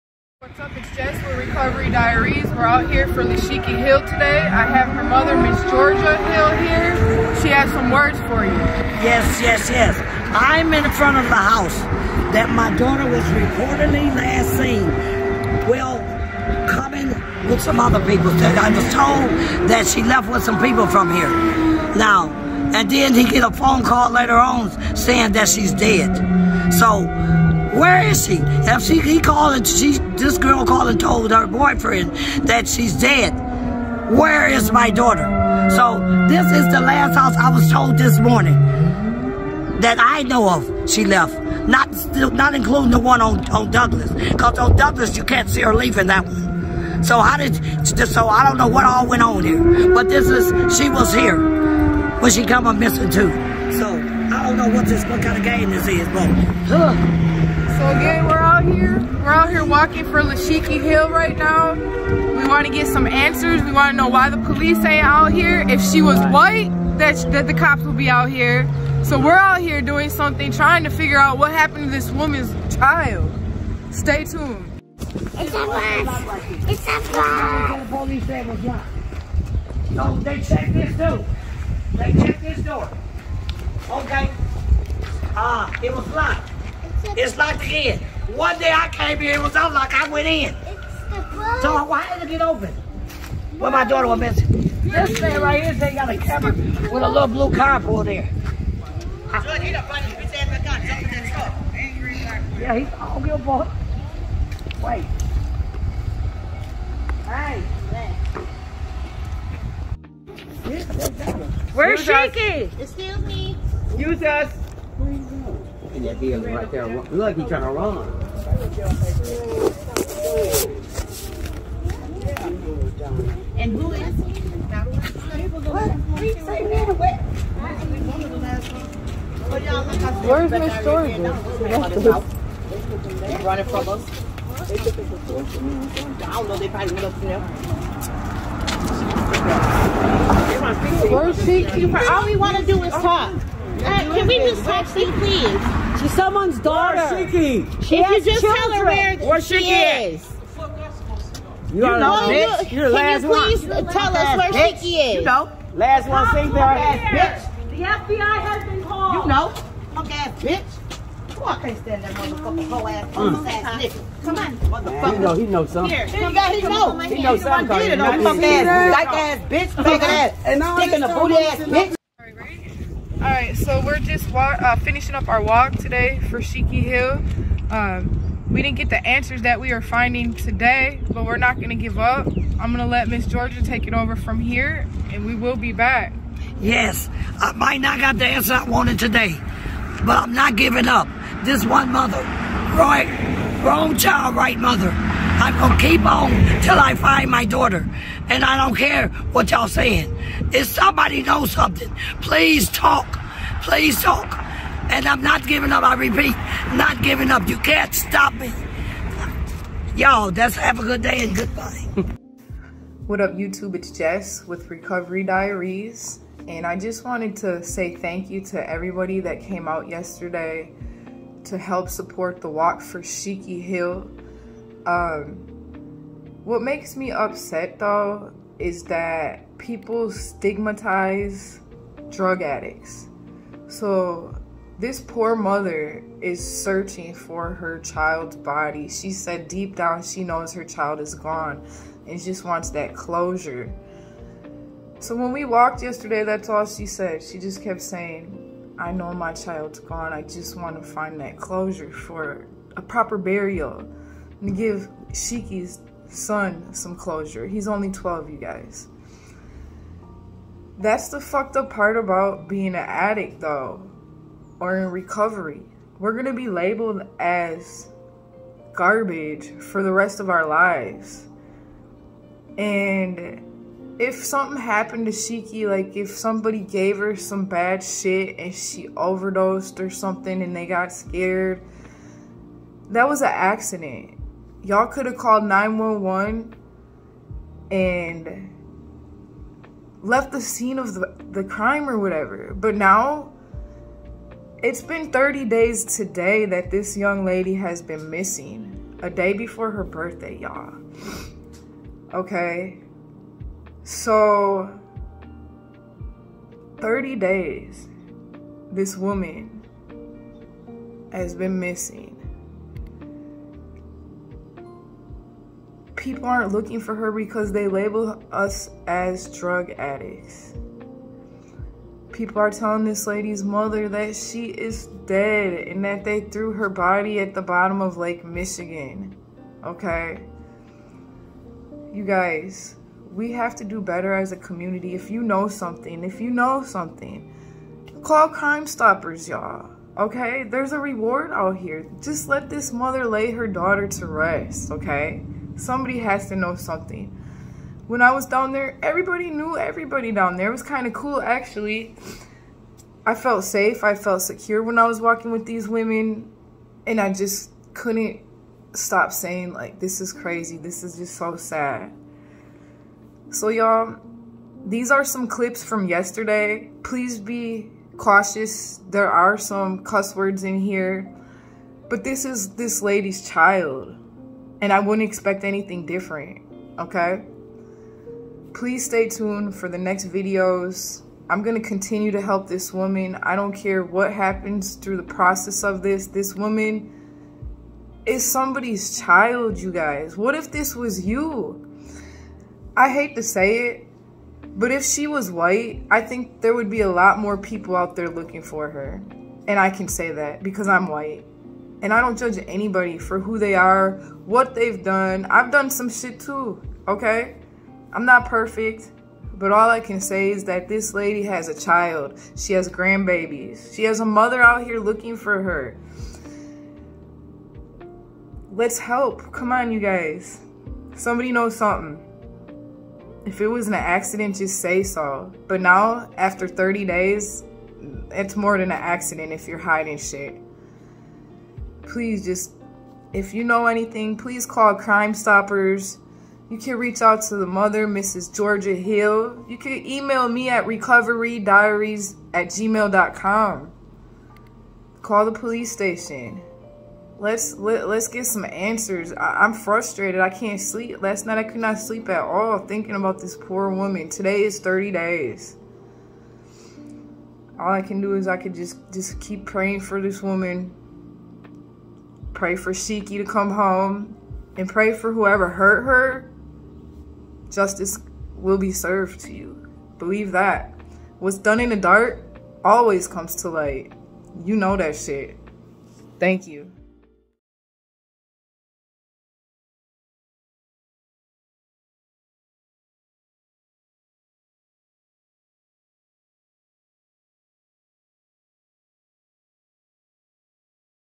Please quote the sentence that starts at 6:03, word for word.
So, y'all, these are some clips from yesterday.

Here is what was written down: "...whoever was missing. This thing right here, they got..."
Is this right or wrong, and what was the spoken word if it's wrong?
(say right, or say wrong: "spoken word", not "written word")
wrong: "daughter", not "whoever".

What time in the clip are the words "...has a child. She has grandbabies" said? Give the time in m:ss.
6:51.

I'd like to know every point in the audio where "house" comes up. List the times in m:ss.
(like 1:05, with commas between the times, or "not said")
0:11, 0:37.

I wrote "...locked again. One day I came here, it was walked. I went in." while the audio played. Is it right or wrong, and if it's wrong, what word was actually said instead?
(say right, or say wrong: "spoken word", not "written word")
wrong: "unlocked", not "walked".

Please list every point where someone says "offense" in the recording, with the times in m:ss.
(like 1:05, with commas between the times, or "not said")
not said.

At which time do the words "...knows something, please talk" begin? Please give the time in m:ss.
3:21.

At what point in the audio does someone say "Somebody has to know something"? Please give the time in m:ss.
5:45.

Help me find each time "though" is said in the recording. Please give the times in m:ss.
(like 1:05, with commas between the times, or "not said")
3:47, 4:23.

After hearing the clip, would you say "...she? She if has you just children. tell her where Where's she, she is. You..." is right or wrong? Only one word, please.
right.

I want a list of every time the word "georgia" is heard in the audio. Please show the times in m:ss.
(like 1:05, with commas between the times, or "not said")
0:05, 2:10, 3:03, 7:18.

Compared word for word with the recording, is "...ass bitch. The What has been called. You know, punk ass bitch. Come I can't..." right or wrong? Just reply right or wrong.
wrong.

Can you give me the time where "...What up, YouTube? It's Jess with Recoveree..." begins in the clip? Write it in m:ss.
3:33.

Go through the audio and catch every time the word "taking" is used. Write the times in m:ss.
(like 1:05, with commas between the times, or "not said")
not said.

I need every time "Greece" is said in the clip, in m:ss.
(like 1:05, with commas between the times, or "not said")
not said.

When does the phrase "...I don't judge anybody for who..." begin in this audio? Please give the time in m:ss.
6:41.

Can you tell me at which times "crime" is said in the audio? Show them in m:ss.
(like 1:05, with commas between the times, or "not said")
4:51, 5:38, 7:14.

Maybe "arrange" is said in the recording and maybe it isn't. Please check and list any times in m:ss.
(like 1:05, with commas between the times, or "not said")
not said.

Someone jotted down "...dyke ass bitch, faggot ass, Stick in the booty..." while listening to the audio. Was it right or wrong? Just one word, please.
right.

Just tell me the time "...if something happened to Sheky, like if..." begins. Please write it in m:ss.
4:34.